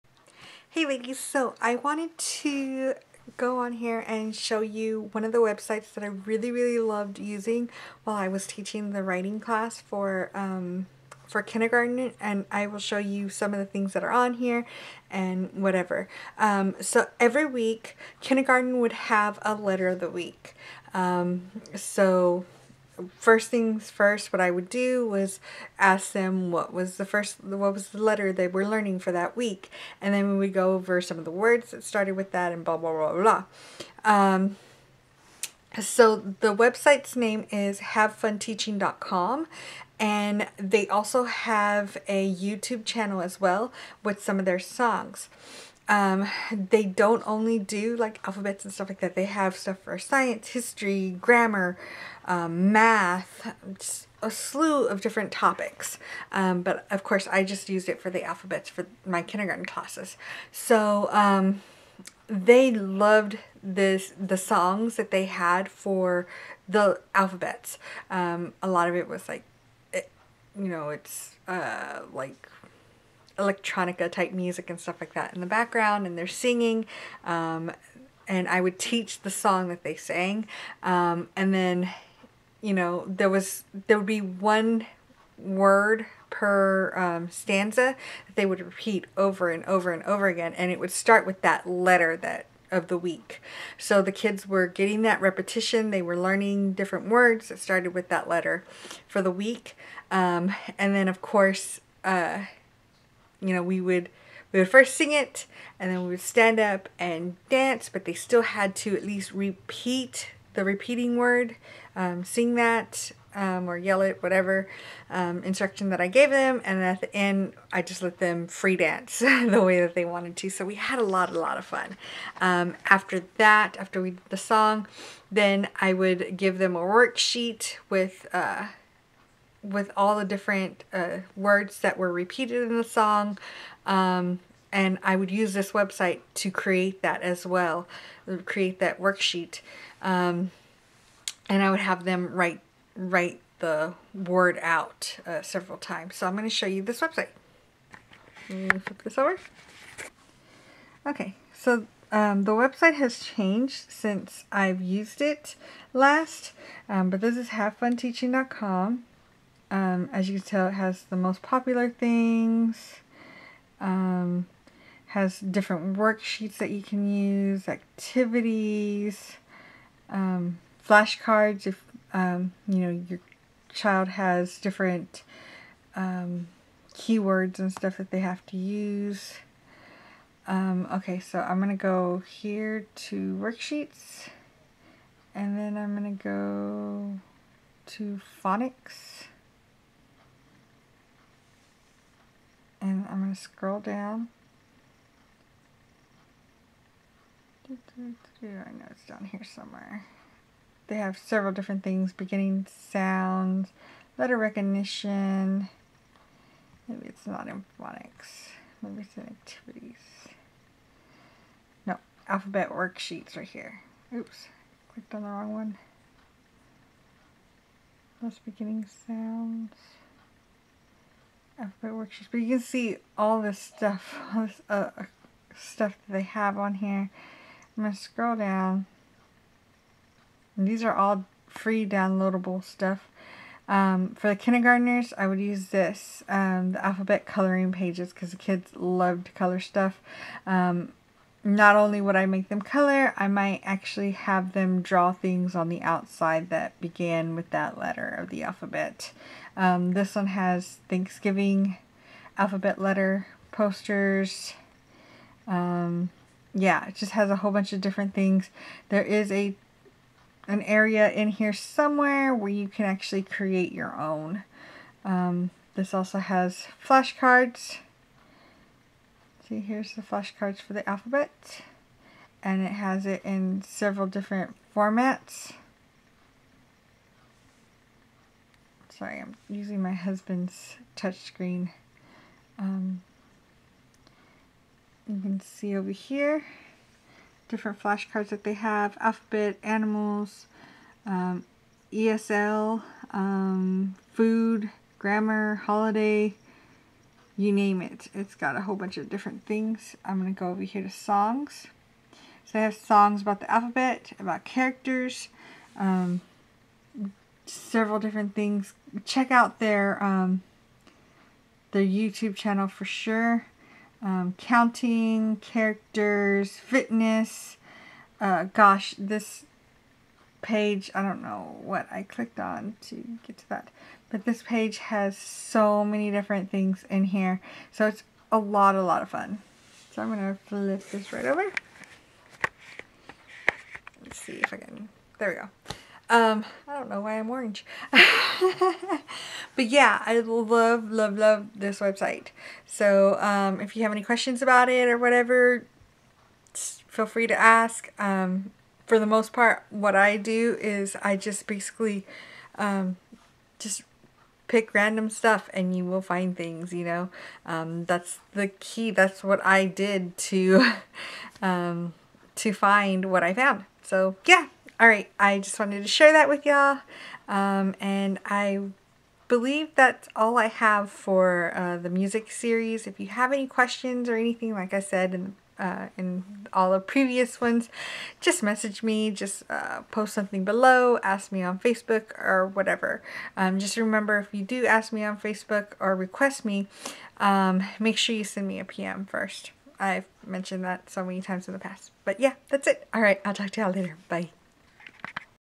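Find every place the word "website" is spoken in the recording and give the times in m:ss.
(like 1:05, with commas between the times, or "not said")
0:05, 0:36, 2:15, 2:27, 2:32, 5:41.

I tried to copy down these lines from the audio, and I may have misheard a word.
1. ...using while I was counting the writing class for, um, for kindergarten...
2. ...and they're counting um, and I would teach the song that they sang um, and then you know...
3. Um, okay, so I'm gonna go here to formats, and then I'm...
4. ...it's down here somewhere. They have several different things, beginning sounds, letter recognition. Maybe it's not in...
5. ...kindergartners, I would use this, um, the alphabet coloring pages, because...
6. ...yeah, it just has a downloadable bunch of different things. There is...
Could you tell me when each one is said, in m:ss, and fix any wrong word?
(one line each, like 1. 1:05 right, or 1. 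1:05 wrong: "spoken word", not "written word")
1. 0:07 wrong: "teaching", not "counting"
2. 1:16 wrong: "singing", not "counting"
3. 3:00 wrong: "worksheets", not "formats"
4. 3:18 right
5. 3:54 right
6. 4:16 wrong: "whole", not "downloadable".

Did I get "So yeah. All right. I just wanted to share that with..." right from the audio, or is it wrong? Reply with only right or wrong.
right.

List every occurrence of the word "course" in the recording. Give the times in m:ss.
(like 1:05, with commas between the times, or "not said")
0:57, 1:41.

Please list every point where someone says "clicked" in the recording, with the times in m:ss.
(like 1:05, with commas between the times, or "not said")
3:34, 5:22.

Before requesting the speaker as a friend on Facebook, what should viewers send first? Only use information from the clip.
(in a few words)
a PM.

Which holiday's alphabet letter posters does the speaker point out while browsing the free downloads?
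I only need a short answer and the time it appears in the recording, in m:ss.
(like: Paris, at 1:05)
Thanksgiving, at 4:10.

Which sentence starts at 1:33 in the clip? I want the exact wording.
So the kids were getting that repetition.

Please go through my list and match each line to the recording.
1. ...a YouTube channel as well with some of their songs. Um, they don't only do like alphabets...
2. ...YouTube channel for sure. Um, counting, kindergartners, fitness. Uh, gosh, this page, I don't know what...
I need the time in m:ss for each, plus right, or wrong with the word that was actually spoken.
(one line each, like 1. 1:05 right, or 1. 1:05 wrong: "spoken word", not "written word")
1. 0:42 right
2. 5:11 wrong: "characters", not "kindergartners".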